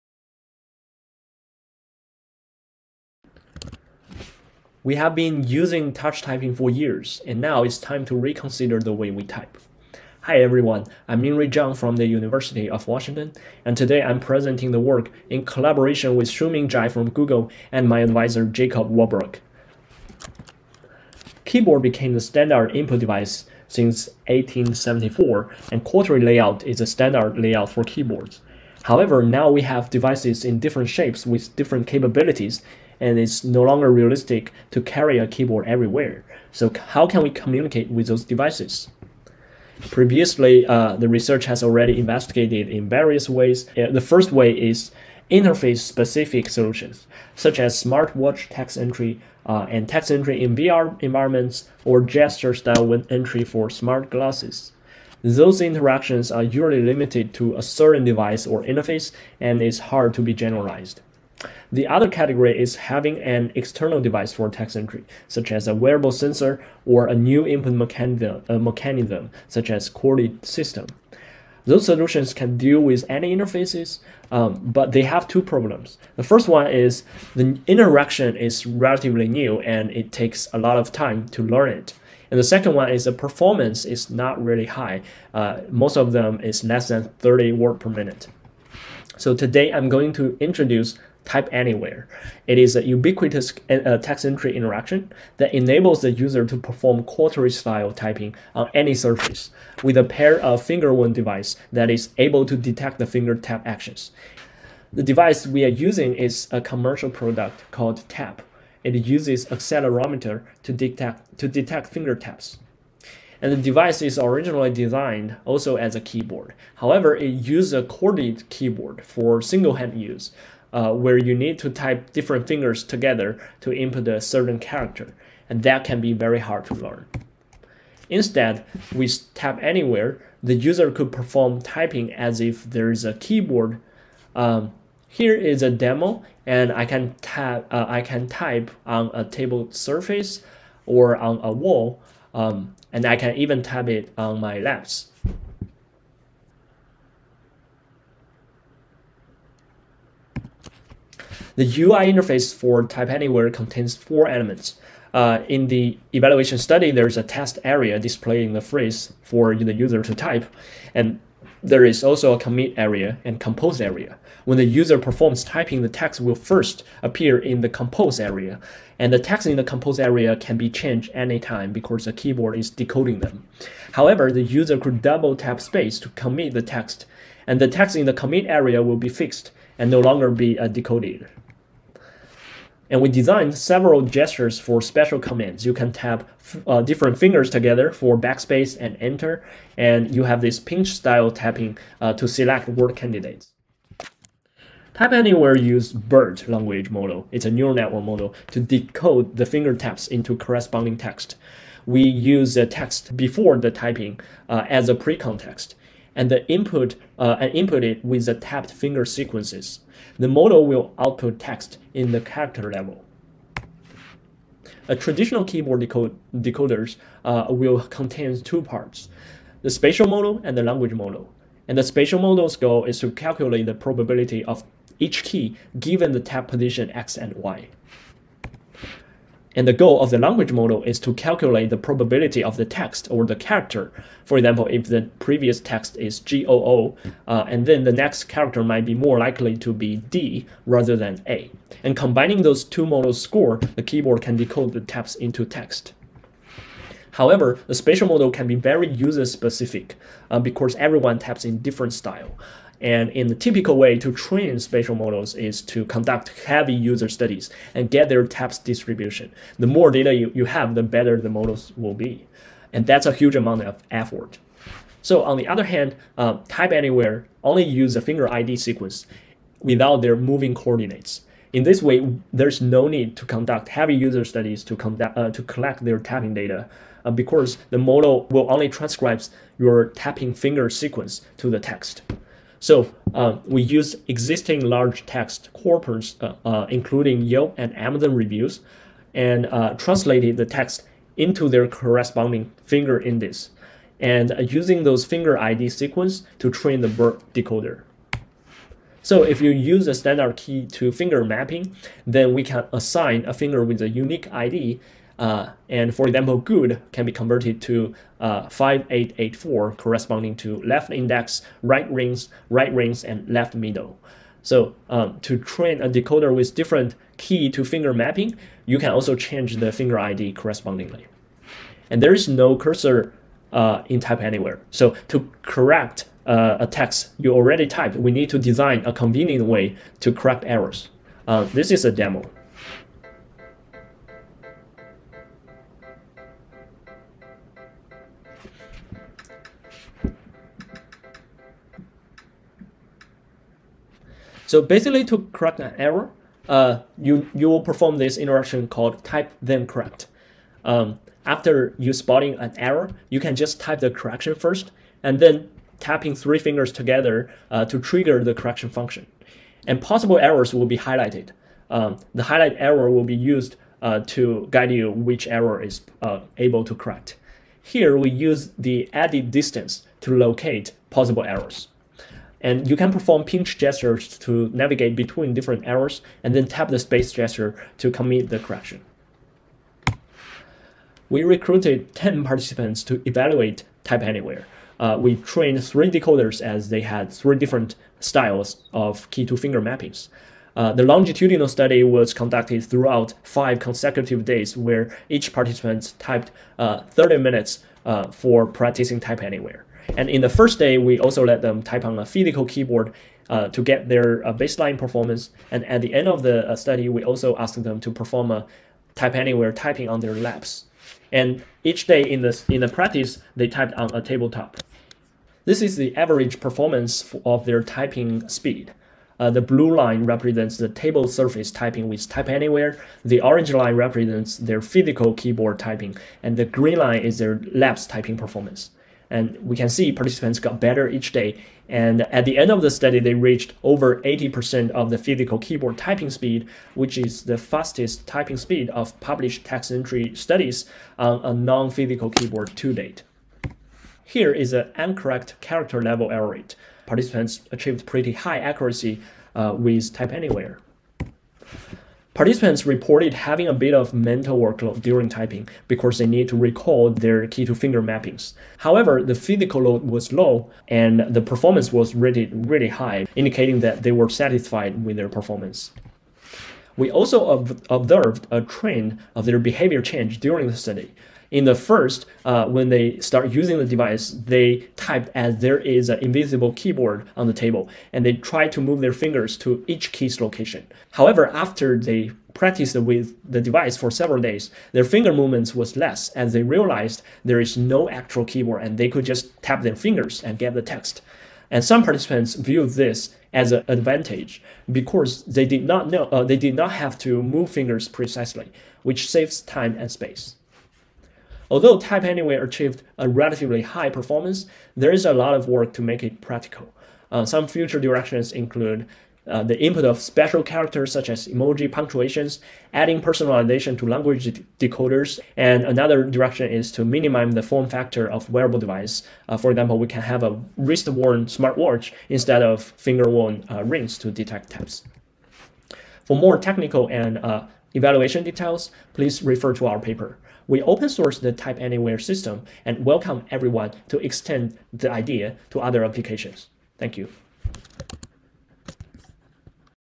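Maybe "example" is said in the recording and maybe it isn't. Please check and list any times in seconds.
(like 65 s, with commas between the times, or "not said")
234 s, 306 s, 519 s.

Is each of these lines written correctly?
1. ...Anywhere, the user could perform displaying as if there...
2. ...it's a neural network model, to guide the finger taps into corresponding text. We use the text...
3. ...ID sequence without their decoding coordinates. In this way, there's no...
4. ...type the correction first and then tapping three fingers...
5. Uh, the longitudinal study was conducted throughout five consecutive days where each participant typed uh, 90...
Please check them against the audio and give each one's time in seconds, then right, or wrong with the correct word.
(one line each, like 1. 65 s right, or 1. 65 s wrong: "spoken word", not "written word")
1. 129 s wrong: "typing", not "displaying"
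2. 197 s wrong: "decode", not "guide"
3. 268 s wrong: "moving", not "decoding"
4. 353 s right
5. 390 s wrong: "30", not "90".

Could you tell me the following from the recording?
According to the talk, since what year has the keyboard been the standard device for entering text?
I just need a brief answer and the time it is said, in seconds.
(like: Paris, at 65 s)
1874, at 24 s.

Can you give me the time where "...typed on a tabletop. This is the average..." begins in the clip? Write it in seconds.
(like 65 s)
413 s.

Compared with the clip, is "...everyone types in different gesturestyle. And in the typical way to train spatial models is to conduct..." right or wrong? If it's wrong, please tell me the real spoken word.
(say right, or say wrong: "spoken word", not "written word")
wrong: "style", not "gesturestyle".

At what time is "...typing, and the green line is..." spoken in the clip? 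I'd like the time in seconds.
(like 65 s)
425 s.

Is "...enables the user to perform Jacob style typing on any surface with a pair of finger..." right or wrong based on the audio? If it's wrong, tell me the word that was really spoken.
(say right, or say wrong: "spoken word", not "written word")
wrong: "QWERTY", not "Jacob".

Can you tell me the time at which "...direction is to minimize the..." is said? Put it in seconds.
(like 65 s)
516 s.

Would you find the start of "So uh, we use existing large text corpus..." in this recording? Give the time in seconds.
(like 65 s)
282 s.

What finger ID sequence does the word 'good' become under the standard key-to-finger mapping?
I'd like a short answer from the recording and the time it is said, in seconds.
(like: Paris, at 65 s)
5884, at 308 s.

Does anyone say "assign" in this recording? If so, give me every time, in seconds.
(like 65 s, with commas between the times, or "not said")
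302 s.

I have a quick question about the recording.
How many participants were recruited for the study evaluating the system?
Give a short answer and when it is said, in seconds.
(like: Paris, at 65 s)
10, at 381 s.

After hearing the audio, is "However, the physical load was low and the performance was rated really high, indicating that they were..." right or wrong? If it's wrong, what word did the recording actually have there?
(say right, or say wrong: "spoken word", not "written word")
right.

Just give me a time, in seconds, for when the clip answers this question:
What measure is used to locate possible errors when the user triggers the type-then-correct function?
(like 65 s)
368 s.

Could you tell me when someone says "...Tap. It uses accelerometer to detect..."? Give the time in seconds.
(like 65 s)
108 s.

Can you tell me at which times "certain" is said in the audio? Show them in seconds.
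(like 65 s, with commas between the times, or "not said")
57 s, 124 s.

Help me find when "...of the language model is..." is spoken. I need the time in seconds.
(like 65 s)
230 s.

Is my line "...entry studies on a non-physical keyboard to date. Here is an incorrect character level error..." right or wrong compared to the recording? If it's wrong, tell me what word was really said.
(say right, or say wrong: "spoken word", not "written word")
right.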